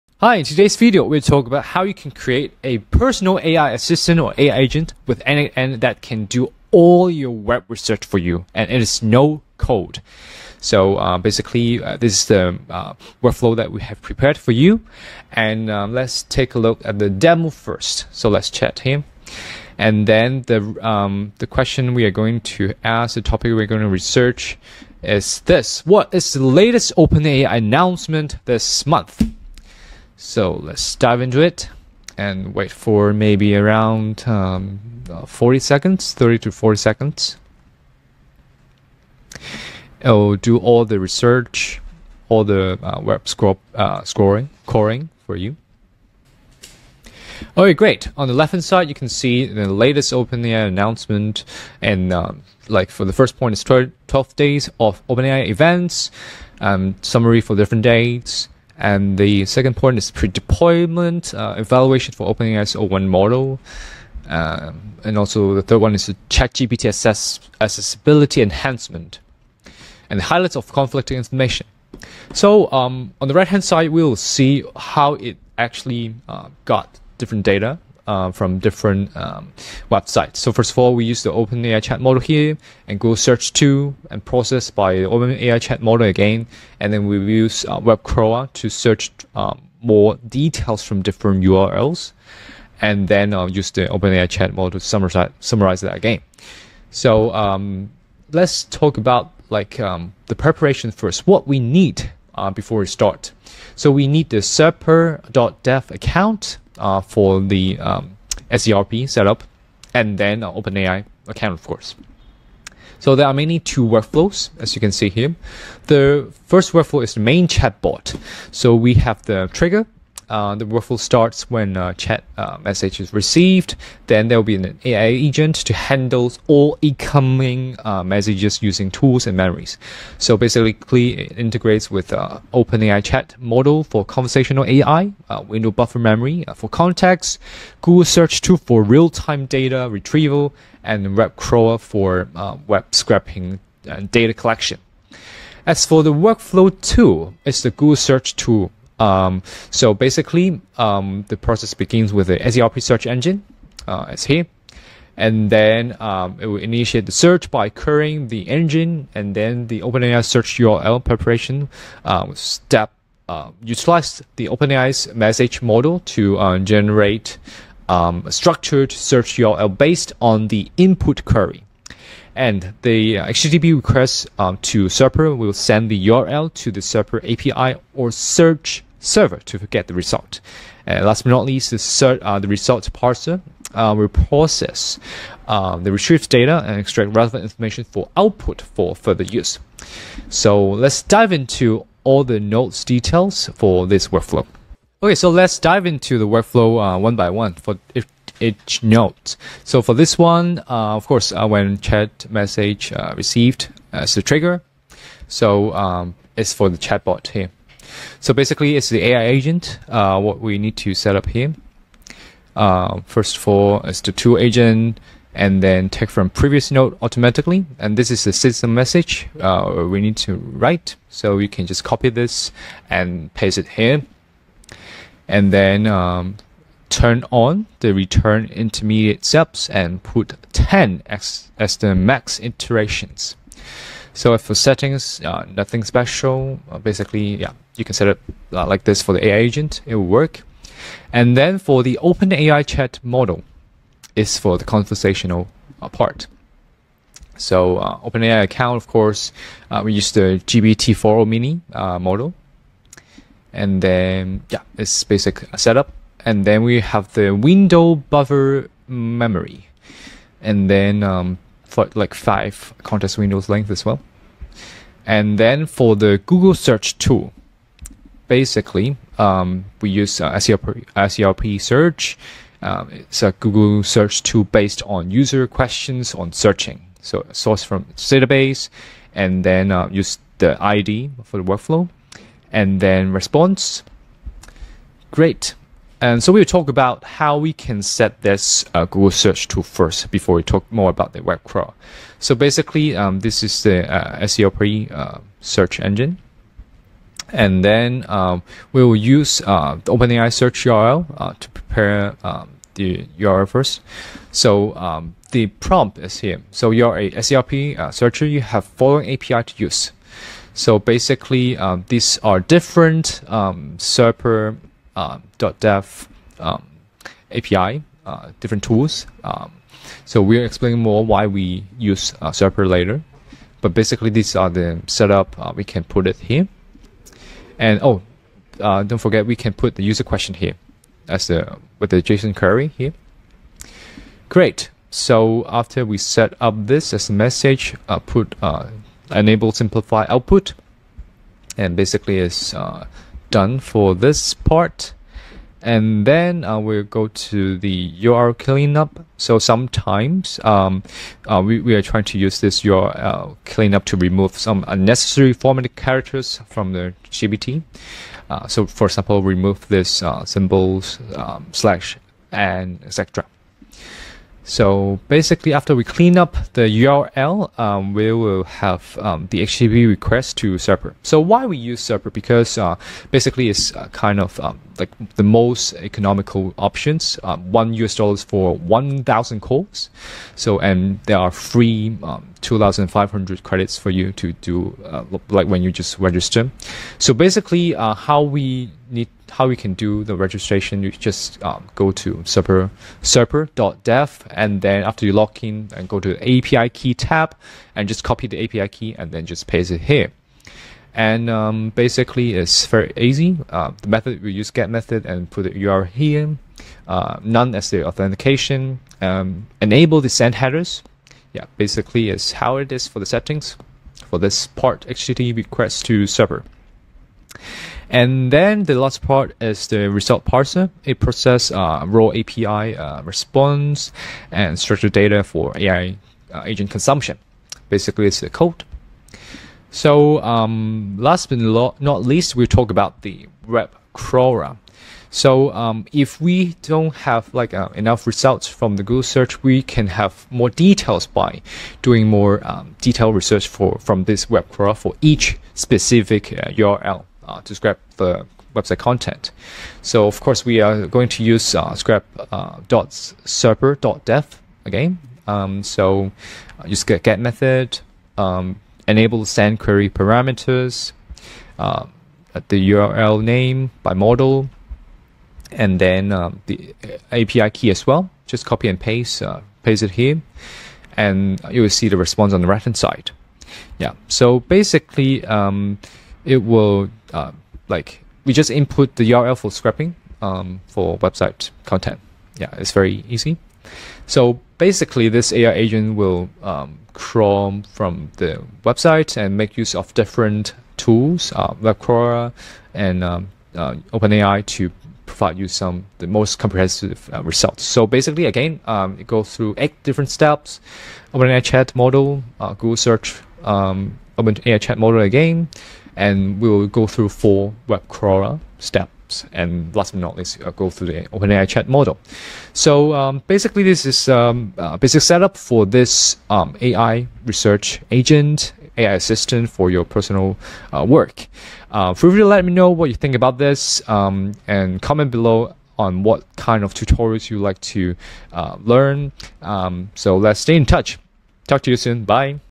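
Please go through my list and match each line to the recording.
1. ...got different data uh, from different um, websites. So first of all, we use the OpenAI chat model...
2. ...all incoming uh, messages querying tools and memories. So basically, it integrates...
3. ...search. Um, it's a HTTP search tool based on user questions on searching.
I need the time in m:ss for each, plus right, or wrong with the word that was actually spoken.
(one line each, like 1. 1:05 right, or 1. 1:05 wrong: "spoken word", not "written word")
1. 1:16 right
2. 2:06 wrong: "using", not "querying"
3. 4:31 wrong: "Google", not "HTTP".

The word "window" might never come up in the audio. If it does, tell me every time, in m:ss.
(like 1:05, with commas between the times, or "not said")
2:15, 4:17, 4:23.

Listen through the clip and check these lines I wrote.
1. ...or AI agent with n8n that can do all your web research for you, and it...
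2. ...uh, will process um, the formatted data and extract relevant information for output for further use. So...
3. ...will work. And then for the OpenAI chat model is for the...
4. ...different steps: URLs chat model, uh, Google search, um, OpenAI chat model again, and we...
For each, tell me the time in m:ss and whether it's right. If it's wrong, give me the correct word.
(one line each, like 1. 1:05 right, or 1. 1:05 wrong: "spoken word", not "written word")
1. 0:04 right
2. 3:03 wrong: "retrieved", not "formatted"
3. 3:59 right
4. 8:19 wrong: "OpenAI", not "URLs".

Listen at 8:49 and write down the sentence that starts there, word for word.
Um, so let's stay in touch.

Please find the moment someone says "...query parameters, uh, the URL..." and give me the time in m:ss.
7:39.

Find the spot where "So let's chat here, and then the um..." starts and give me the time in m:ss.
0:18.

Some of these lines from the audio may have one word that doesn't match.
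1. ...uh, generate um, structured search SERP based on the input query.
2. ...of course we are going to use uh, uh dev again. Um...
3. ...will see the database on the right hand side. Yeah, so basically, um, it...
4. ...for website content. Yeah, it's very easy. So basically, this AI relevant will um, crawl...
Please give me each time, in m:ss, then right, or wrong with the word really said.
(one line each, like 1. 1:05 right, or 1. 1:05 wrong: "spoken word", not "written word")
1. 2:46 wrong: "URL", not "SERP"
2. 7:30 right
3. 7:51 wrong: "response", not "database"
4. 8:00 wrong: "agent", not "relevant".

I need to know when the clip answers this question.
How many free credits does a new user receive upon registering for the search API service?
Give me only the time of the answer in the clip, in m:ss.
6:22.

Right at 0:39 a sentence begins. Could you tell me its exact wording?
It'll oh, do all the research, all the uh, web scroll, uh, scoring, coring for you.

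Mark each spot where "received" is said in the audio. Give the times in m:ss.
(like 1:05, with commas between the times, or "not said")
2:03, 3:23.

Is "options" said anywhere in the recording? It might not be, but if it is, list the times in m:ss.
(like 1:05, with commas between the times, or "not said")
6:16.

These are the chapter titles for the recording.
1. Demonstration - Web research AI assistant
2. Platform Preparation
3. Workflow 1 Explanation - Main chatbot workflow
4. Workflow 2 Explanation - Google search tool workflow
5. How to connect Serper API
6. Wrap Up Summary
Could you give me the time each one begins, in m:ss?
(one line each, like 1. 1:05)
1. 0:15
2. 1:39
3. 3:14
4. 4:45
5. 6:28
6. 8:33.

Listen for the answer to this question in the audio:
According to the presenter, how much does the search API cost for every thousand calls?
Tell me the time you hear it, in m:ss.
6:17.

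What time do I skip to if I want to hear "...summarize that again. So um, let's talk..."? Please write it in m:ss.
1:35.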